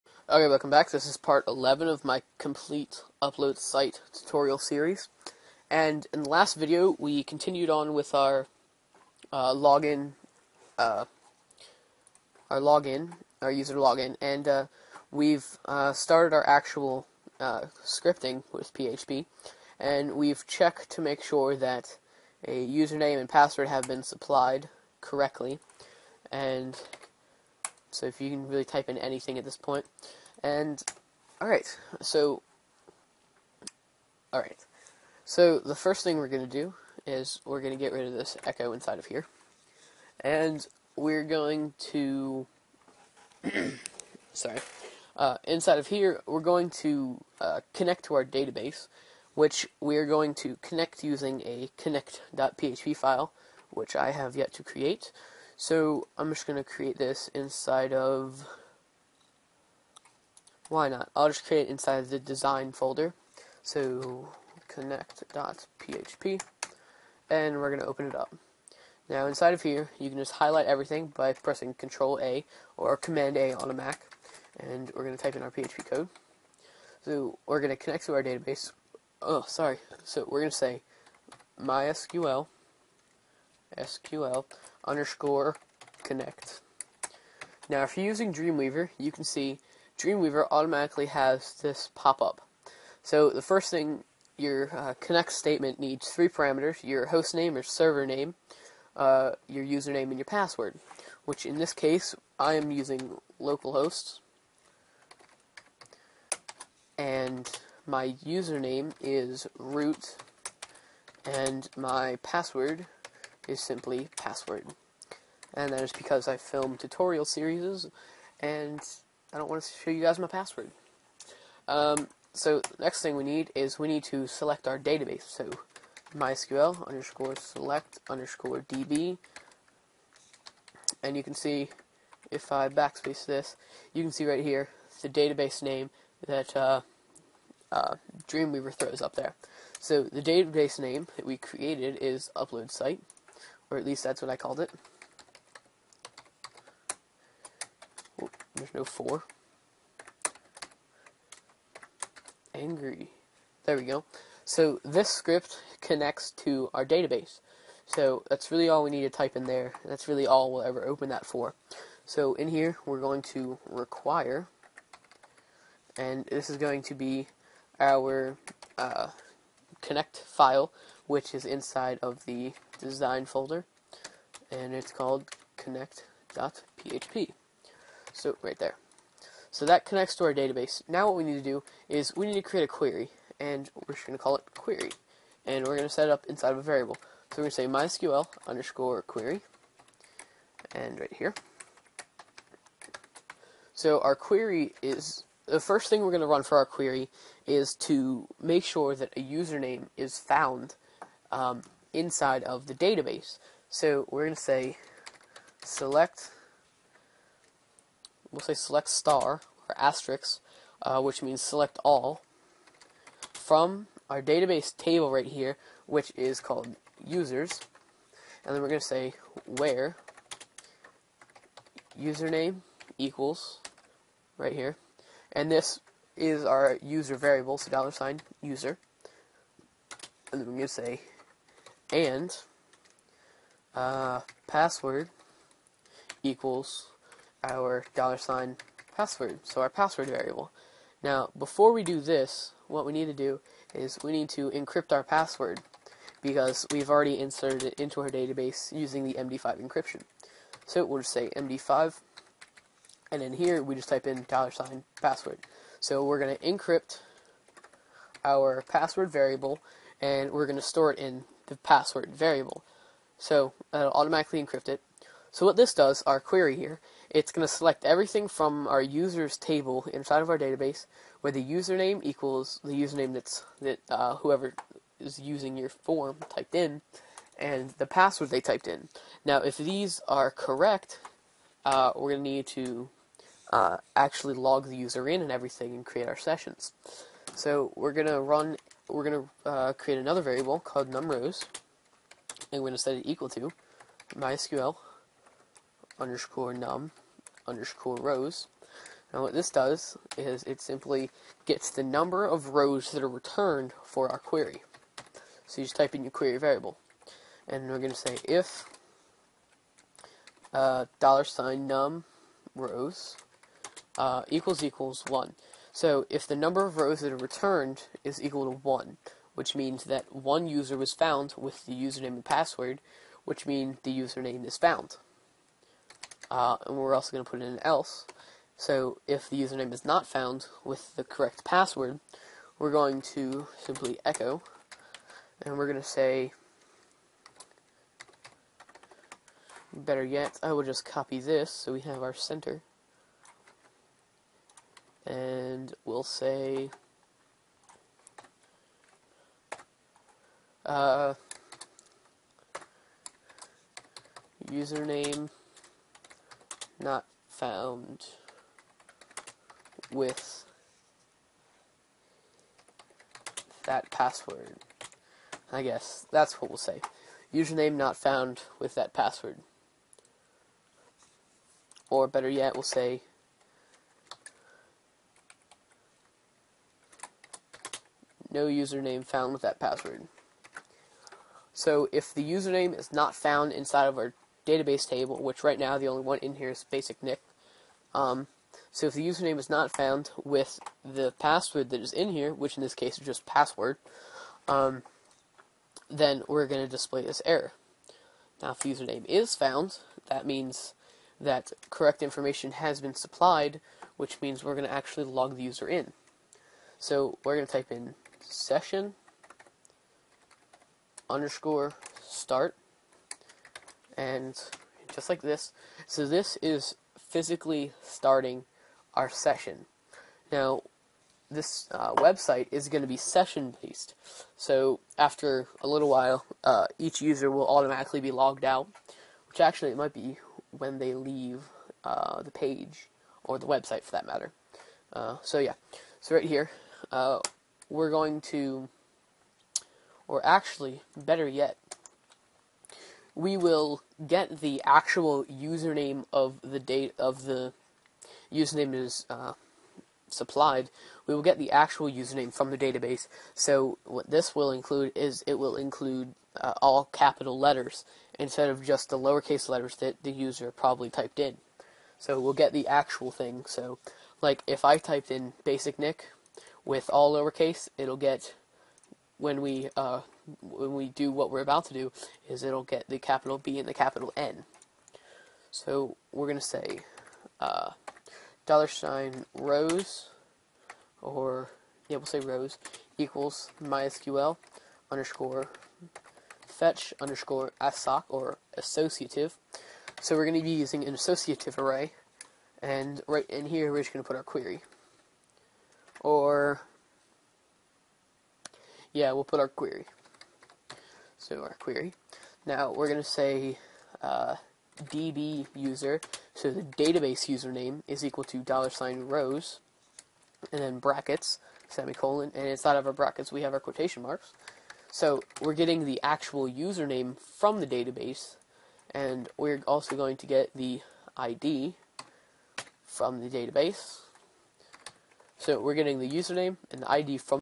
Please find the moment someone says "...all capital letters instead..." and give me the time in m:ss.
7:36.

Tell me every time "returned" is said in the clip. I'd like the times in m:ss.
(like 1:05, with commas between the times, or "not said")
5:03, 5:17.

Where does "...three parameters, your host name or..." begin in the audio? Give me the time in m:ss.
1:36.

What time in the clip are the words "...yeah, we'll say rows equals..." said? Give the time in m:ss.
8:01.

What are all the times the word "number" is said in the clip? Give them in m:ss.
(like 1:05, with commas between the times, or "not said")
5:01, 5:16.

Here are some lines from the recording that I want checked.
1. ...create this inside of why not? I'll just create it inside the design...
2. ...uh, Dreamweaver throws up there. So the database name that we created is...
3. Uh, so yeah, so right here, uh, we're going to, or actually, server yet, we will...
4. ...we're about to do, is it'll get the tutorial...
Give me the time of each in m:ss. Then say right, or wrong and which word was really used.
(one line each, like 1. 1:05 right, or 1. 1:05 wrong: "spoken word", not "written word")
1. 0:56 right
2. 2:17 right
3. 7:14 wrong: "better", not "server"
4. 7:51 wrong: "capital", not "tutorial".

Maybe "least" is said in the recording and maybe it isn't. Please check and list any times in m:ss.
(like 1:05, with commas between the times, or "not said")
2:23.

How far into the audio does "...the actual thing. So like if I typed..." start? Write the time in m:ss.
7:42.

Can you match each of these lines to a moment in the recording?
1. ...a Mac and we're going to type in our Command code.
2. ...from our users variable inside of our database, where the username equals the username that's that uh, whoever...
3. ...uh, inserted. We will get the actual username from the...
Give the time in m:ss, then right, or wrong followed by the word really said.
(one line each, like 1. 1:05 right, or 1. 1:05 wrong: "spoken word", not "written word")
1. 1:13 wrong: "PHP", not "Command"
2. 4:28 wrong: "table", not "variable"
3. 7:29 wrong: "supplied", not "inserted".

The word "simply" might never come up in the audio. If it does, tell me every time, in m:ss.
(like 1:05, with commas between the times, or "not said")
1:53, 5:00, 5:33.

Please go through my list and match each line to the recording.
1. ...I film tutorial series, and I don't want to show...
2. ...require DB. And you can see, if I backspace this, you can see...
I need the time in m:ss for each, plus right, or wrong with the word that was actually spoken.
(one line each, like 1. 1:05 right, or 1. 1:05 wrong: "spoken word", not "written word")
1. 1:56 right
2. 2:08 wrong: "underscore", not "require".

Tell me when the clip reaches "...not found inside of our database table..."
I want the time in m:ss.
6:22.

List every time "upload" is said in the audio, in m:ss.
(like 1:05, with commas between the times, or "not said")
0:03, 2:22.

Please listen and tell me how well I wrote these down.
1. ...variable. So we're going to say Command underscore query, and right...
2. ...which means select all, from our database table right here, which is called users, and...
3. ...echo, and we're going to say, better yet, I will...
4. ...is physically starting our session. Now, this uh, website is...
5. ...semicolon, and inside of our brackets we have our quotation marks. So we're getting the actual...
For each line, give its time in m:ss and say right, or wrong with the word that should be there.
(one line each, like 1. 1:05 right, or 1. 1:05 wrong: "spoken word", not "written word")
1. 3:06 wrong: "MySQL", not "Command"
2. 3:31 right
3. 5:34 right
4. 6:56 right
5. 8:31 right.